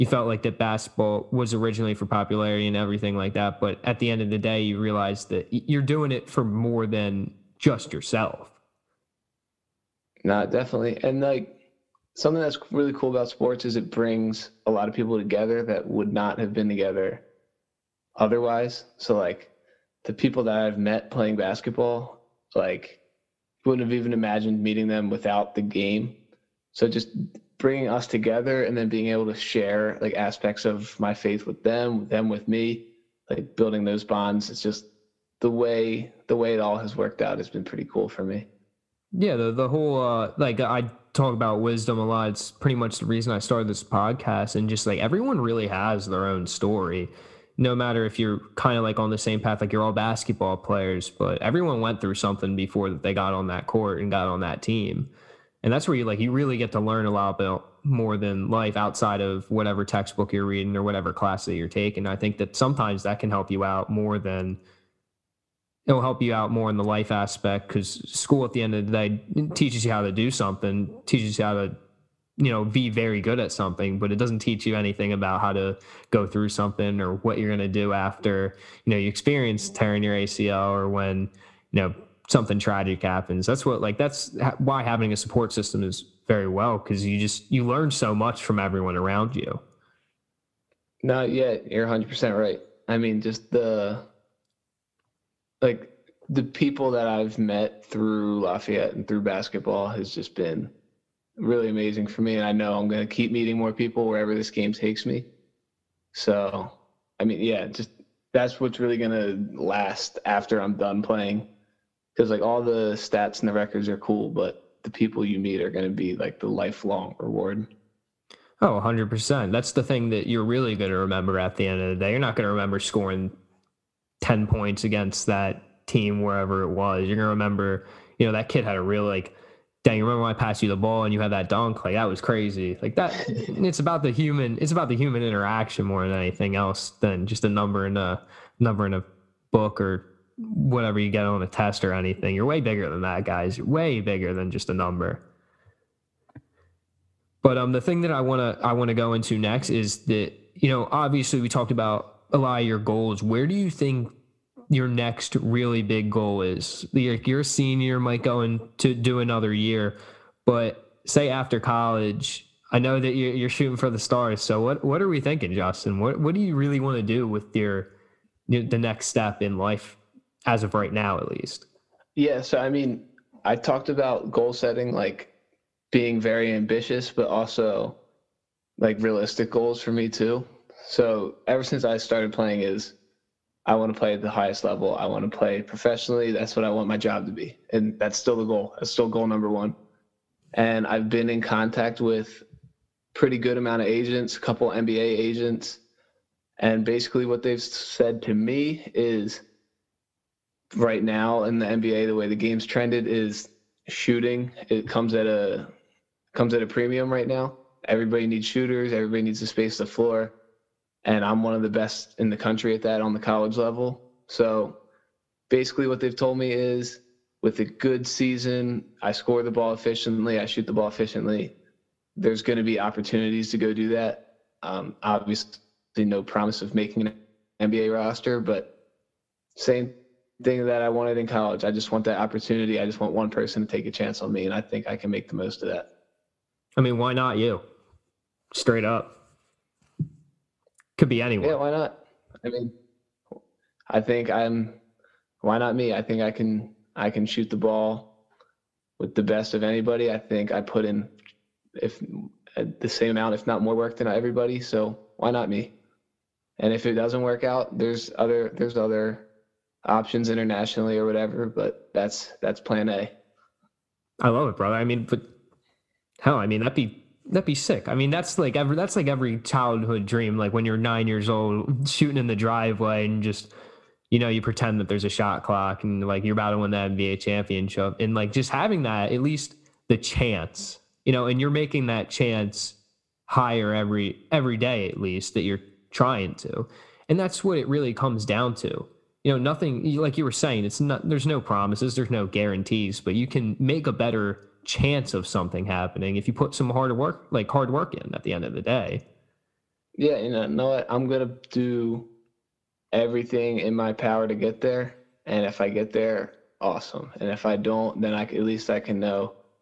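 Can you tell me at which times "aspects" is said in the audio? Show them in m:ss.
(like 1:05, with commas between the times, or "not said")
0:30, 1:07.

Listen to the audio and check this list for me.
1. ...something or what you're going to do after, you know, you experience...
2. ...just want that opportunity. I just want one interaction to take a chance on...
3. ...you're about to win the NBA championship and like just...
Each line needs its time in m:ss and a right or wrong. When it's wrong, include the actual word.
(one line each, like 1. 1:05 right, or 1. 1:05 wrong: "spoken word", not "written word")
1. 1:16 right
2. 3:51 wrong: "person", not "interaction"
3. 4:36 right.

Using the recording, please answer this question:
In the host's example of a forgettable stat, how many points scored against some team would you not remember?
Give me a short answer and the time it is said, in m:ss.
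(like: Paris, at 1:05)
10, at 2:04.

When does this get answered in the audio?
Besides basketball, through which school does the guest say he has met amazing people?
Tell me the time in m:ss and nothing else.
1:38.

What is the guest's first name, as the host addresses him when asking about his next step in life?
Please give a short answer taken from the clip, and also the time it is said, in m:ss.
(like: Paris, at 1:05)
Justin, at 2:45.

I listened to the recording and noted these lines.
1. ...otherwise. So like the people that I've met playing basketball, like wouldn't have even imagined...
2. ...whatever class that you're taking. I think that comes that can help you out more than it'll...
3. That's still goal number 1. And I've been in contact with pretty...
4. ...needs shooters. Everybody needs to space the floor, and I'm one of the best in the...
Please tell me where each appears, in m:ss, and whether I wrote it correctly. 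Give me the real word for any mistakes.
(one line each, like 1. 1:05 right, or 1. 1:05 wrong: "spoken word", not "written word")
1. 0:18 right
2. 1:00 wrong: "sometimes", not "comes"
3. 3:08 right
4. 3:28 right.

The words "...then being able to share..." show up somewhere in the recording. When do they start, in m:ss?
0:28.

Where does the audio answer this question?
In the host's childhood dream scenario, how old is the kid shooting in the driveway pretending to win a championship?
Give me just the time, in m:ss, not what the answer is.
4:30.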